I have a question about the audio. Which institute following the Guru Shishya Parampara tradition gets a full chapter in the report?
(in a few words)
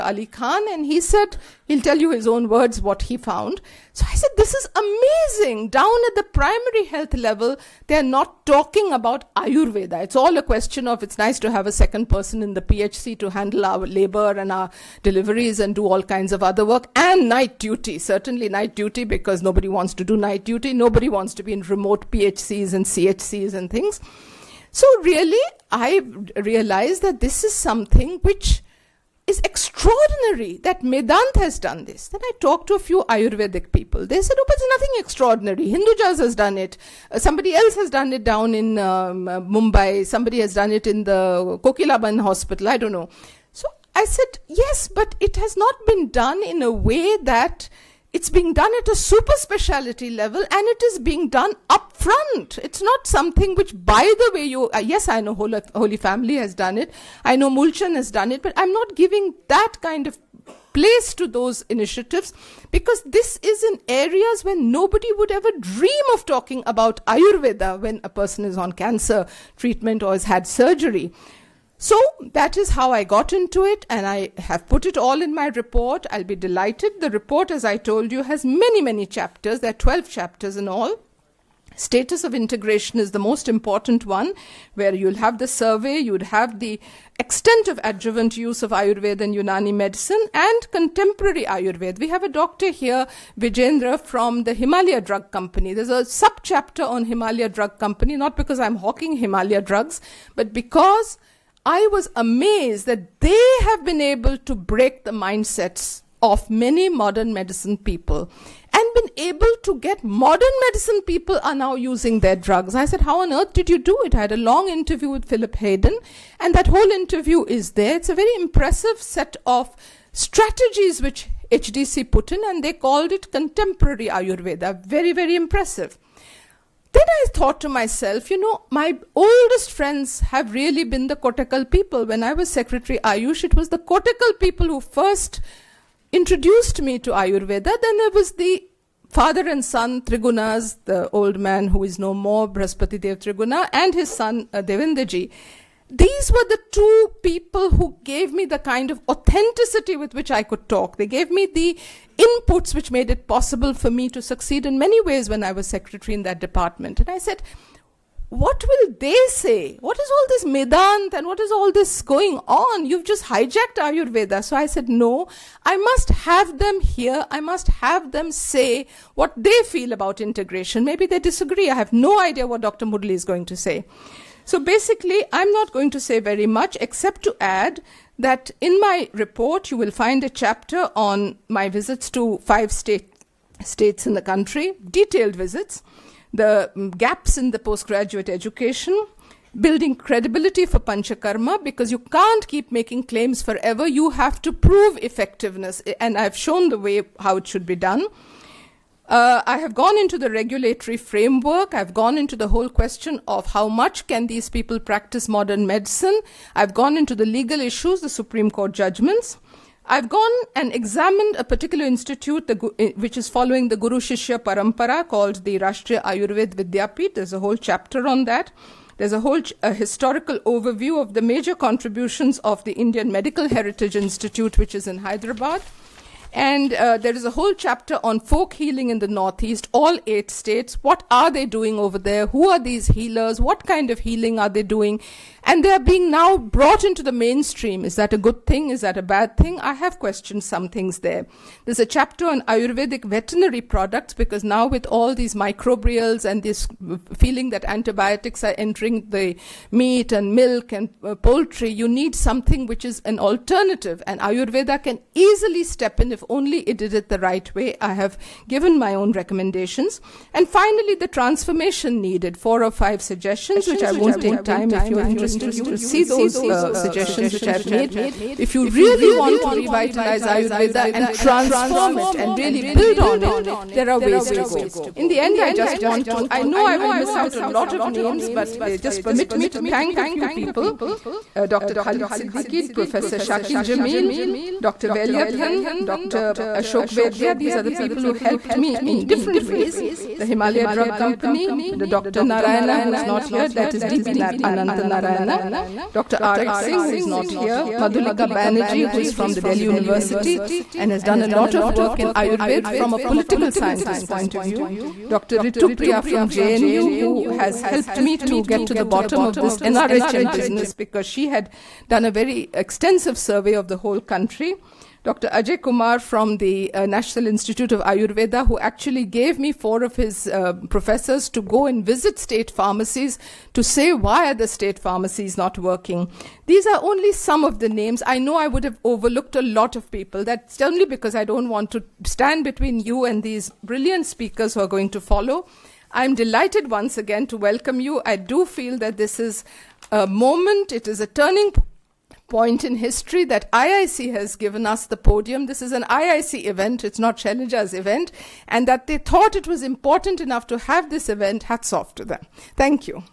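Rashtriya Ayurved Vidyapeeth.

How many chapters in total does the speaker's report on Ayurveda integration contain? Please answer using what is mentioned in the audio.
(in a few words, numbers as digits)
12.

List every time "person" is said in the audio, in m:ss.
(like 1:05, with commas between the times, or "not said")
0:12, 1:08.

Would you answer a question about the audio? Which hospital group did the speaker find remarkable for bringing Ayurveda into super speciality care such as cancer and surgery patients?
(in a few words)
Medanta.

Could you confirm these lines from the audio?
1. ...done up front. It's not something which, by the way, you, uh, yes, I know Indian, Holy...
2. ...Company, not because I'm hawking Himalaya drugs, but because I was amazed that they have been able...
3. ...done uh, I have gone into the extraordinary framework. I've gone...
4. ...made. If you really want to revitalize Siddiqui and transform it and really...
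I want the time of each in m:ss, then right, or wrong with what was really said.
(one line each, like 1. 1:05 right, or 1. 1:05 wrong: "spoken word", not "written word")
1. 0:51 wrong: "Holy", not "Indian"
2. 1:37 right
3. 3:17 wrong: "regulatory", not "extraordinary"
4. 4:27 wrong: "Ayurveda", not "Siddiqui".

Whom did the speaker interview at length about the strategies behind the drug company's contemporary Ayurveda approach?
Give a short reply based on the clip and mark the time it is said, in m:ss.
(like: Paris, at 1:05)
Philip Haydon, at 1:55.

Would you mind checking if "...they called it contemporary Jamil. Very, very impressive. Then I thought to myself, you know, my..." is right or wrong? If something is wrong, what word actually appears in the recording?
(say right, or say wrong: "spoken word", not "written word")
wrong: "Ayurveda", not "Jamil".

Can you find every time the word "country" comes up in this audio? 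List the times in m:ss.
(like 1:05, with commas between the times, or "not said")
3:04, 5:13.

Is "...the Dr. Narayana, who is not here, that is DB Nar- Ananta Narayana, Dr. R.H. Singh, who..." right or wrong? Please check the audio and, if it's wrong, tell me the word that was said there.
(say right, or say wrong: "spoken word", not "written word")
right.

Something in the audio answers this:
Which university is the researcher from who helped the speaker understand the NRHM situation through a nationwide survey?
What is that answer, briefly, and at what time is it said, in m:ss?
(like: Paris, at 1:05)
JNU, at 5:06.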